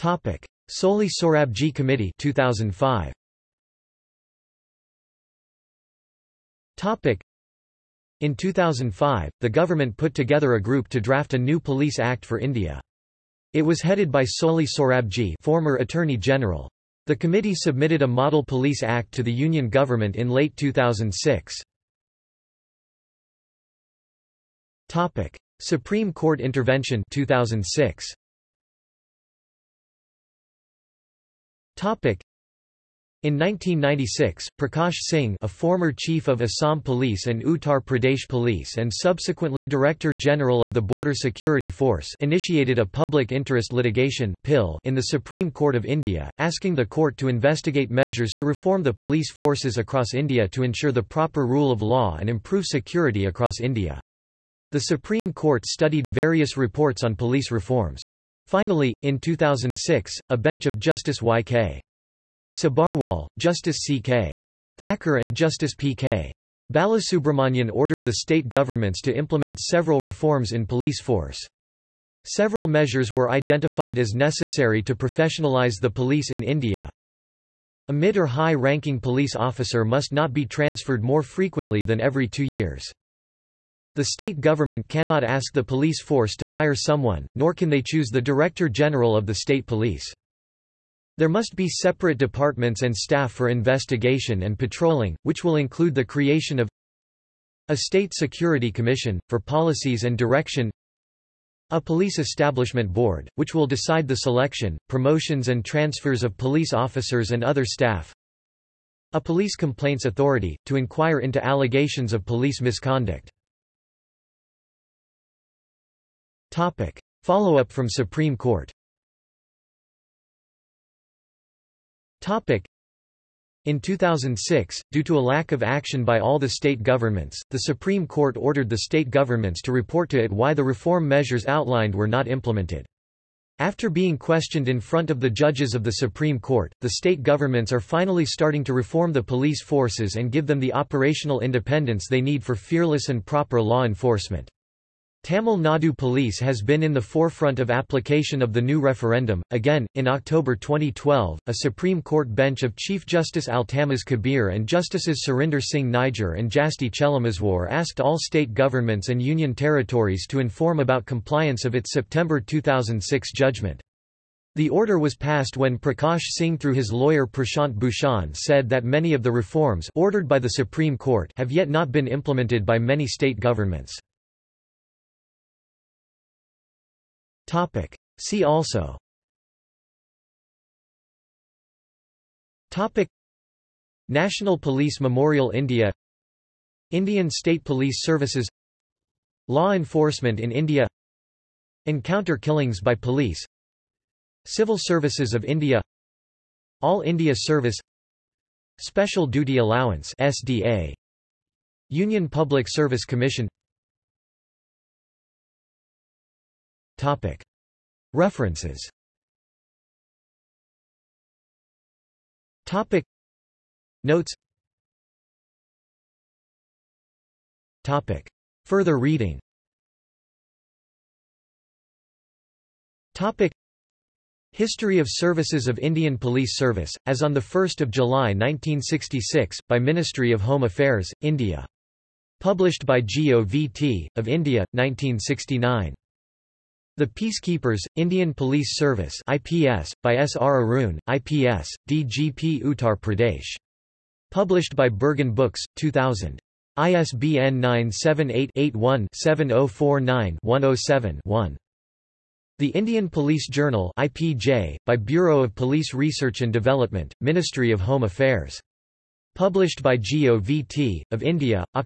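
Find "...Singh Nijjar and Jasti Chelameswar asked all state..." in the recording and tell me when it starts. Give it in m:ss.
2:35.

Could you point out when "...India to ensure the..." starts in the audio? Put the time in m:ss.
0:50.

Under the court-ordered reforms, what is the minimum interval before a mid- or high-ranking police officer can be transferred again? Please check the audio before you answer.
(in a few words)
2 years.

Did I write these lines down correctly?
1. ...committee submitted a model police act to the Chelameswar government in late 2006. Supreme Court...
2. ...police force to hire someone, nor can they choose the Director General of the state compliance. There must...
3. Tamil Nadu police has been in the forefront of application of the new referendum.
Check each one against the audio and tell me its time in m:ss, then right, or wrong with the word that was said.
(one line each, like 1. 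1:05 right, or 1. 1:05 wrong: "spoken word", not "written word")
1. 0:17 wrong: "Union", not "Chelameswar"
2. 1:25 wrong: "police", not "compliance"
3. 2:25 right.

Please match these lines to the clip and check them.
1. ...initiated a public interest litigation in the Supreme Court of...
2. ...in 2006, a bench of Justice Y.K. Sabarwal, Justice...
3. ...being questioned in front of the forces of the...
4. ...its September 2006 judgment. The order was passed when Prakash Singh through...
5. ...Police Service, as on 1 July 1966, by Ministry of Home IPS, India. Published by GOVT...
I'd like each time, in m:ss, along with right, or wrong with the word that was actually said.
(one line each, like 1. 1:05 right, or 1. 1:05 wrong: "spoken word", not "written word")
1. 0:42 right
2. 0:59 right
3. 2:13 wrong: "judges", not "forces"
4. 2:41 right
5. 3:46 wrong: "Affairs", not "IPS".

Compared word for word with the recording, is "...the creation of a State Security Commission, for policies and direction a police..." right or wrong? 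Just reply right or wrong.
right.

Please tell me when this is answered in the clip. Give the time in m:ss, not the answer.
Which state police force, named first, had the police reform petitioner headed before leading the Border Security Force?
0:36.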